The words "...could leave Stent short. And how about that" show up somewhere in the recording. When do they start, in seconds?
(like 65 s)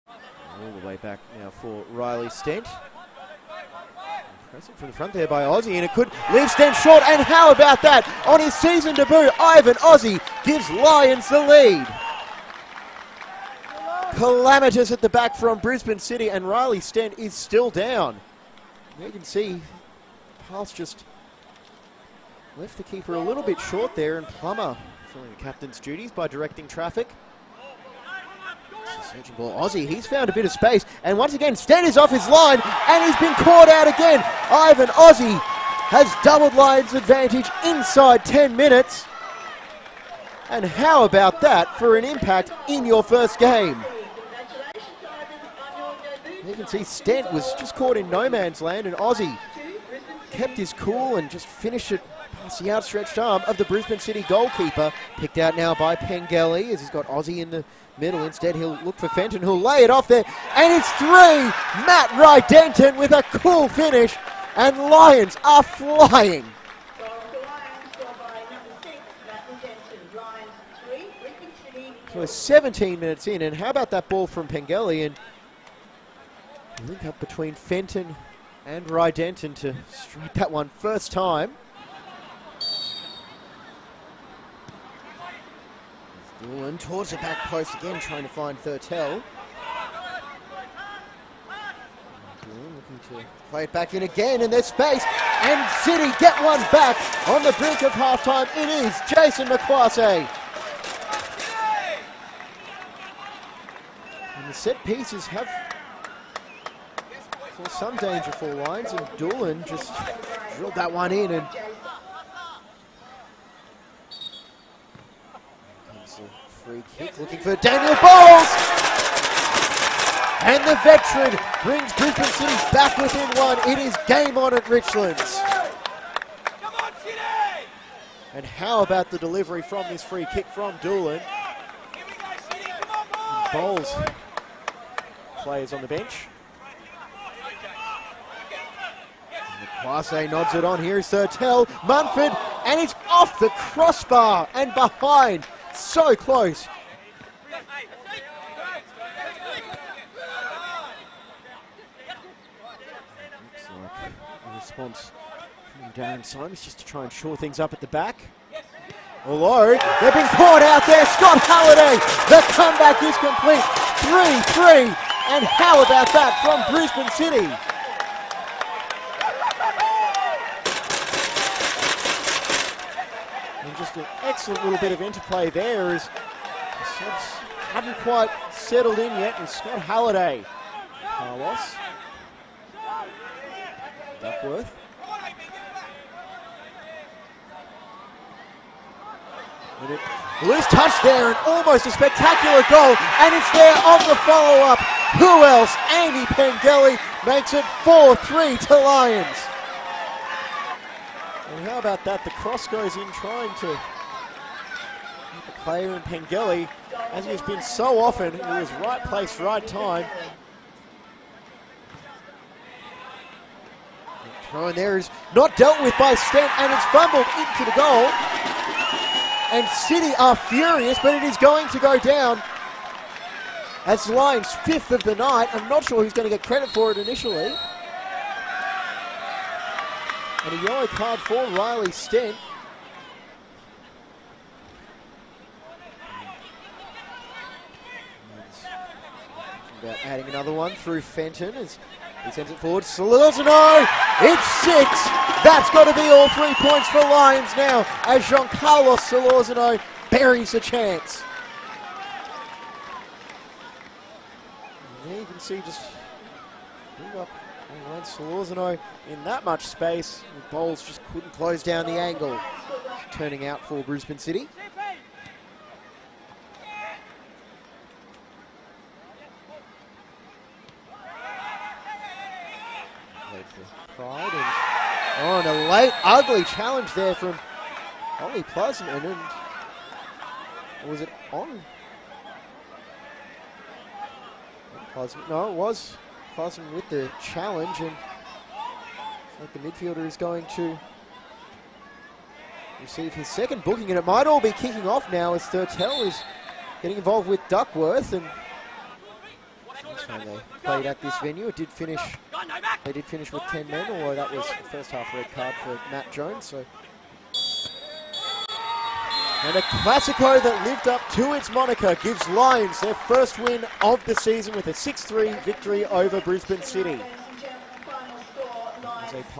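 5 s.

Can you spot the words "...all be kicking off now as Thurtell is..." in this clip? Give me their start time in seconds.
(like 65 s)
294 s.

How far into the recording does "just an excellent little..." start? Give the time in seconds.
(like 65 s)
173 s.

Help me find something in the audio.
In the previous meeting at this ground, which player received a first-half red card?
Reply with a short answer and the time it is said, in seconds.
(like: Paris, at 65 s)
Matt Jones, at 305 s.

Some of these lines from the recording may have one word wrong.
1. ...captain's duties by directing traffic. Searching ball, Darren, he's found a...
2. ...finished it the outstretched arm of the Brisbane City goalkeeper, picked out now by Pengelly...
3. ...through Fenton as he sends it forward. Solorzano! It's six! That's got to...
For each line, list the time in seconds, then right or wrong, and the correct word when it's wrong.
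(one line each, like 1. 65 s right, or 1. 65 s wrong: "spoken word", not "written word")
1. 25 s wrong: "Aussie", not "Darren"
2. 51 s right
3. 240 s right.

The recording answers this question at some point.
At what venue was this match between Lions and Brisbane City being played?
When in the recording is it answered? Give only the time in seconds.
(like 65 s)
124 s.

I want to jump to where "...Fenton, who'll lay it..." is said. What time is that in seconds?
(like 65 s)
59 s.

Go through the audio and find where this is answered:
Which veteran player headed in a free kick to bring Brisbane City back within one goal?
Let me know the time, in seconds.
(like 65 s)
117 s.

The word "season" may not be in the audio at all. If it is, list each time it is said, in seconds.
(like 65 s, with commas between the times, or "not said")
8 s, 314 s.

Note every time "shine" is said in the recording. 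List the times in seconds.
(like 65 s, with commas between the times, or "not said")
not said.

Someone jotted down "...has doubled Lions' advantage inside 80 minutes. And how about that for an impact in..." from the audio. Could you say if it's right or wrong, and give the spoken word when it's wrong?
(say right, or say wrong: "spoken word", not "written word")
wrong: "10", not "80".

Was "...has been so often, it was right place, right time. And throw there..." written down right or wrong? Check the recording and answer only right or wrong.
right.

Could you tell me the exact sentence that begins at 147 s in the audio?
Looks like a response from Darren Simons just to try and shore things up at the back.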